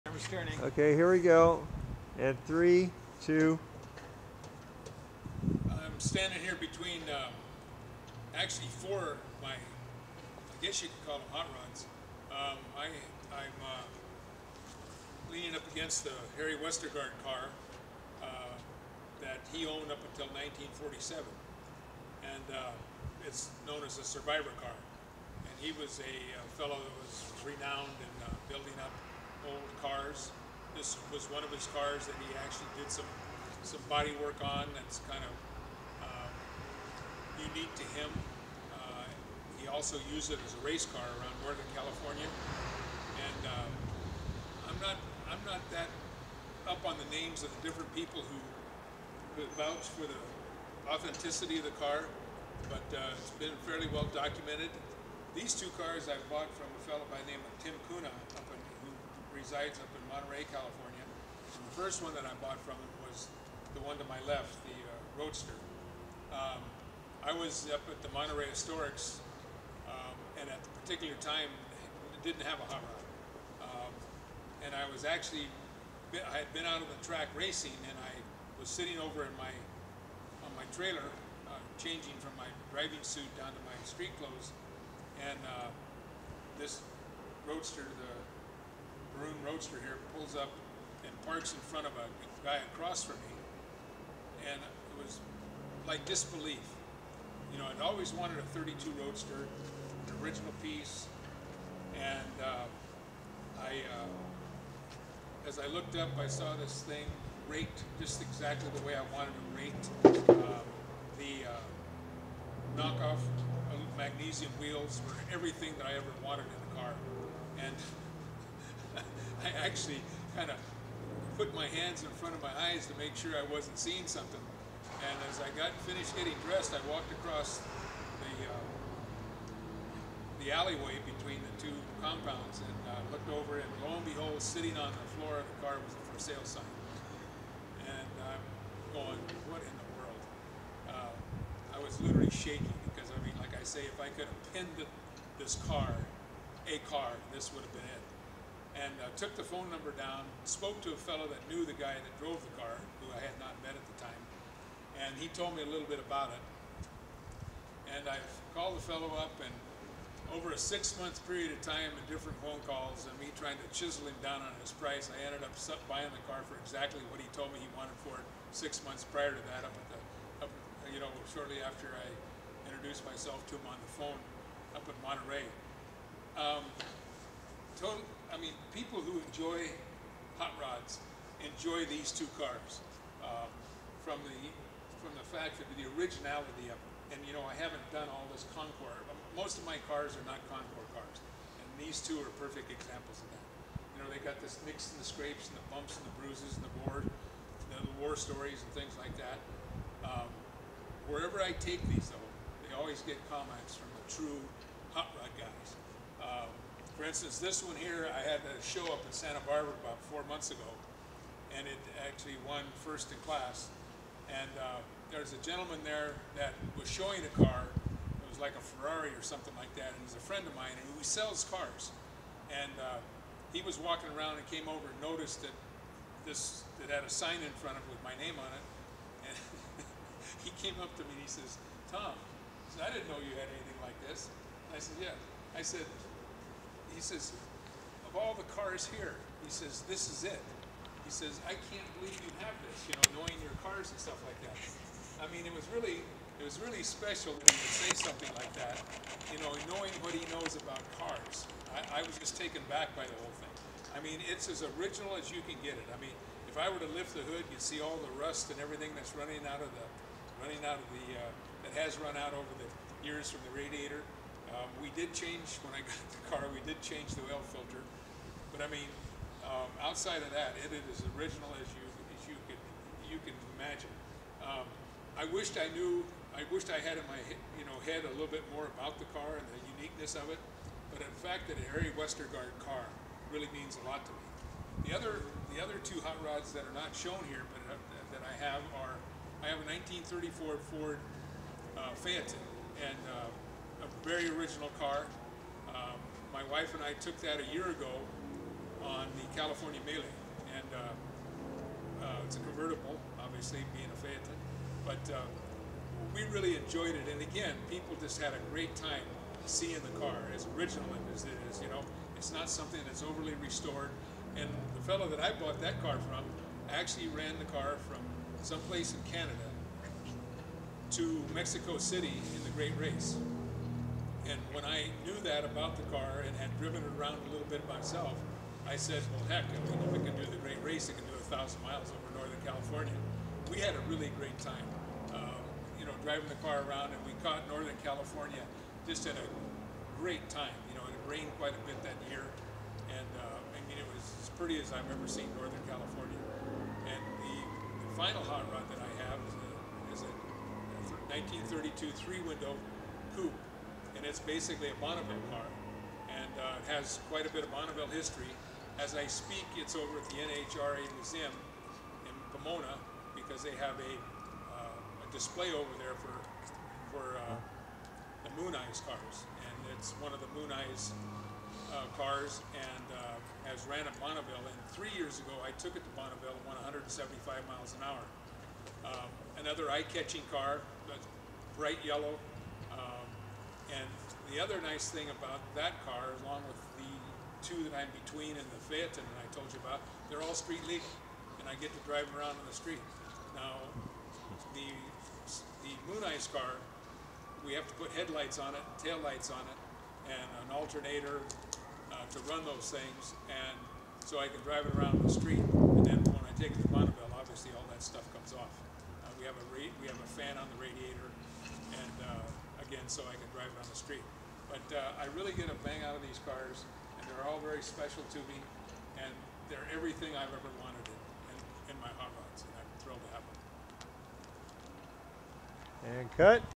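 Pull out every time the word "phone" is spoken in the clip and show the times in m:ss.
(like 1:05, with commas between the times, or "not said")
2:29, 2:42, 2:53.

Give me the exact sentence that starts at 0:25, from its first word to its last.
And he was a, fellow that was renowned in uh, building up old cars.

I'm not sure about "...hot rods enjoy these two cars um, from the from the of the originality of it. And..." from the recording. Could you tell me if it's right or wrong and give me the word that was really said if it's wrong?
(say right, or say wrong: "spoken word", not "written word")
right.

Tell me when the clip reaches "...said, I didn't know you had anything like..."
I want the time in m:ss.
3:52.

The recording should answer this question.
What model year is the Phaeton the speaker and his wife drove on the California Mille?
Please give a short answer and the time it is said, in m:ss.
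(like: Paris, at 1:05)
1934, at 4:49.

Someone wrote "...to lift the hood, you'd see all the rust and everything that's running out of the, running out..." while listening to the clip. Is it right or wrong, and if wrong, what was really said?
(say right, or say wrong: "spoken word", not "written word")
right.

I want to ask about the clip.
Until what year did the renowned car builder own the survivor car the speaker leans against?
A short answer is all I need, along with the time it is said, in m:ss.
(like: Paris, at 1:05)
1947, at 0:20.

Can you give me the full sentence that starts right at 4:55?
Um, my wife and I took that a year ago on the California Mille.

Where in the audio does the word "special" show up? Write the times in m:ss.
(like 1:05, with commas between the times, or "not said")
4:06, 6:57.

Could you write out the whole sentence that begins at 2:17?
And I'm going, what in the world?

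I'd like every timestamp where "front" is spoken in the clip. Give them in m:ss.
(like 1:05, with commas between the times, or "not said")
1:31, 2:02, 3:47.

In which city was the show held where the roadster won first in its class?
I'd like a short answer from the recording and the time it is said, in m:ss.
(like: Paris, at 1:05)
Santa Barbara, at 3:29.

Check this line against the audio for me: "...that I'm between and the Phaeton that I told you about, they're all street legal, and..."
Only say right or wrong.
right.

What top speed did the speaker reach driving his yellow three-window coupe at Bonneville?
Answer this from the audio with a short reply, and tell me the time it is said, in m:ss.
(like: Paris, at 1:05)
175 mph, at 6:16.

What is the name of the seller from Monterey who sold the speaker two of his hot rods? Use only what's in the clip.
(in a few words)
Tim Kuna.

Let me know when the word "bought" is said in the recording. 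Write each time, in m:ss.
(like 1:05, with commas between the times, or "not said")
0:56, 1:02, 5:15.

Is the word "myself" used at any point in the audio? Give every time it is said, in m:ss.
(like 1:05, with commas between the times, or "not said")
2:53, 5:27.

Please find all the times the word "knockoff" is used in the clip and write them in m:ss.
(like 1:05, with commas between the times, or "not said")
1:52.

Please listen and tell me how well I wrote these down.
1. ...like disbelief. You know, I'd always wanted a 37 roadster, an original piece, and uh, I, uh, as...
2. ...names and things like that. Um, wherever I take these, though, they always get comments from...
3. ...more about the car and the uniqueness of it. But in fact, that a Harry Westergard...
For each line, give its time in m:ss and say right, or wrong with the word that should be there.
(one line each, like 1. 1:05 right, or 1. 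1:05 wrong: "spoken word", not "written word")
1. 1:35 wrong: "32", not "37"
2. 3:18 wrong: "stories", not "names"
3. 4:38 right.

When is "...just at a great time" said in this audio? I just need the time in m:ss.
5:38.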